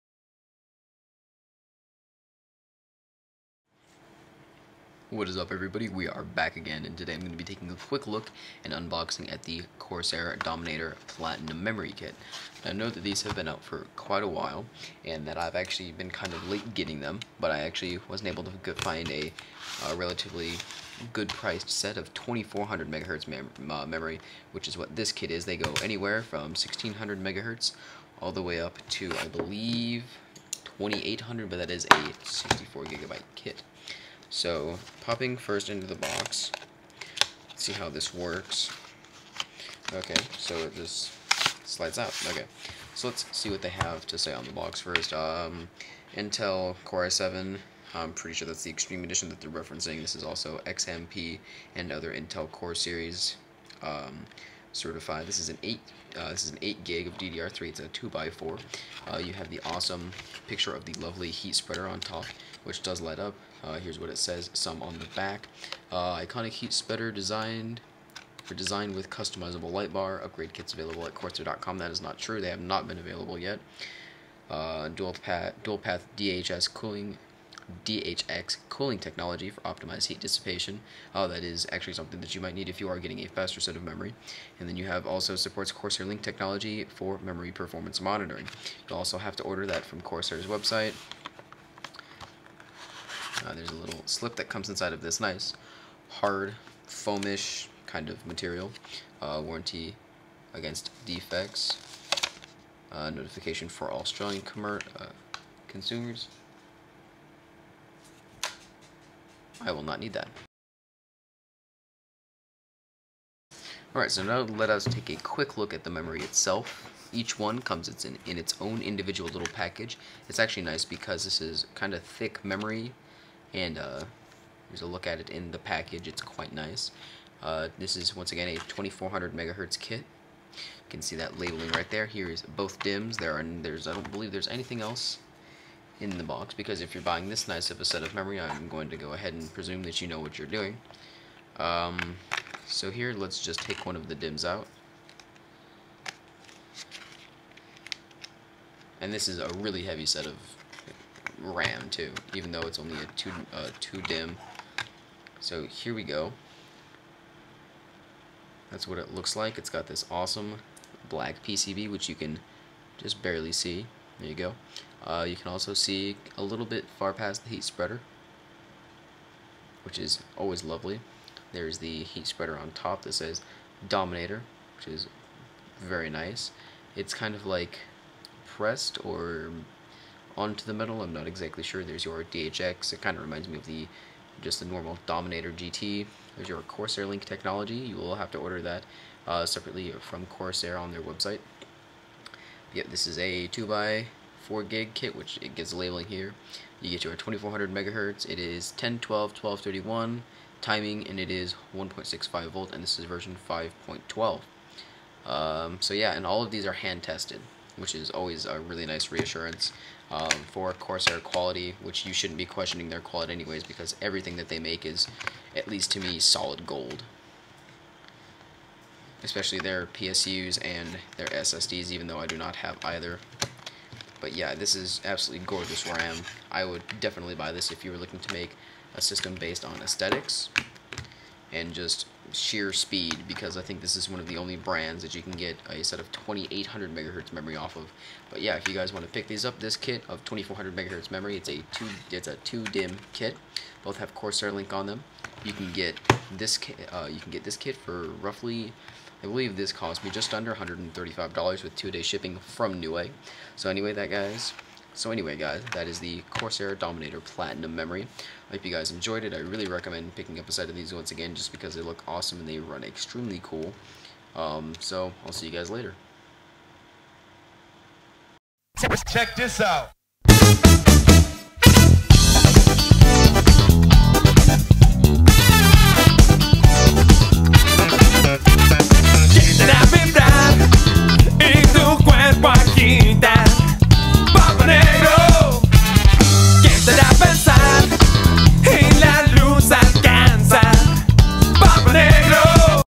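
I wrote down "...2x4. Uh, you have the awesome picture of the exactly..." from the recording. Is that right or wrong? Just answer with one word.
wrong.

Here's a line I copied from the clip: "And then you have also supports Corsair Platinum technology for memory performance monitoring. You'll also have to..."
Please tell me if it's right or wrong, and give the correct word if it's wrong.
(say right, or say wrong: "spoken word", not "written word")
wrong: "Link", not "Platinum".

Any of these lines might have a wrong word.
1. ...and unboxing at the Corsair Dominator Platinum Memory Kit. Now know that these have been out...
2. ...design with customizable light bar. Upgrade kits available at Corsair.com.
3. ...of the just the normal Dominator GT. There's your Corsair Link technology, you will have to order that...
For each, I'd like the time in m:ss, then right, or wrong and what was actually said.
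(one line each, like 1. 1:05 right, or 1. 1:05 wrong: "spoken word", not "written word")
1. 0:08 right
2. 1:08 right
3. 3:03 right.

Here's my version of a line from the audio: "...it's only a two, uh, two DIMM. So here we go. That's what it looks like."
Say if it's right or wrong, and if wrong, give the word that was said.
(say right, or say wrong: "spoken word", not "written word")
right.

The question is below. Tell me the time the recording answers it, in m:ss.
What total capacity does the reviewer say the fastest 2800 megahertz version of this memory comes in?
0:32.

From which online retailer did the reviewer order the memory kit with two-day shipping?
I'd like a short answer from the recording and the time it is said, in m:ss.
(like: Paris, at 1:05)
Newegg, at 4:12.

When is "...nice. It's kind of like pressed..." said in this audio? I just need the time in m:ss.
2:56.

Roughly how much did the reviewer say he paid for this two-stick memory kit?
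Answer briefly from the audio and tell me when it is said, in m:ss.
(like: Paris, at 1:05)
Just under $135, at 4:10.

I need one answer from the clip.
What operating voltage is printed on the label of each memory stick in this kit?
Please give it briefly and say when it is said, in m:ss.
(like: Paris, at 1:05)
1.65 volt, at 3:21.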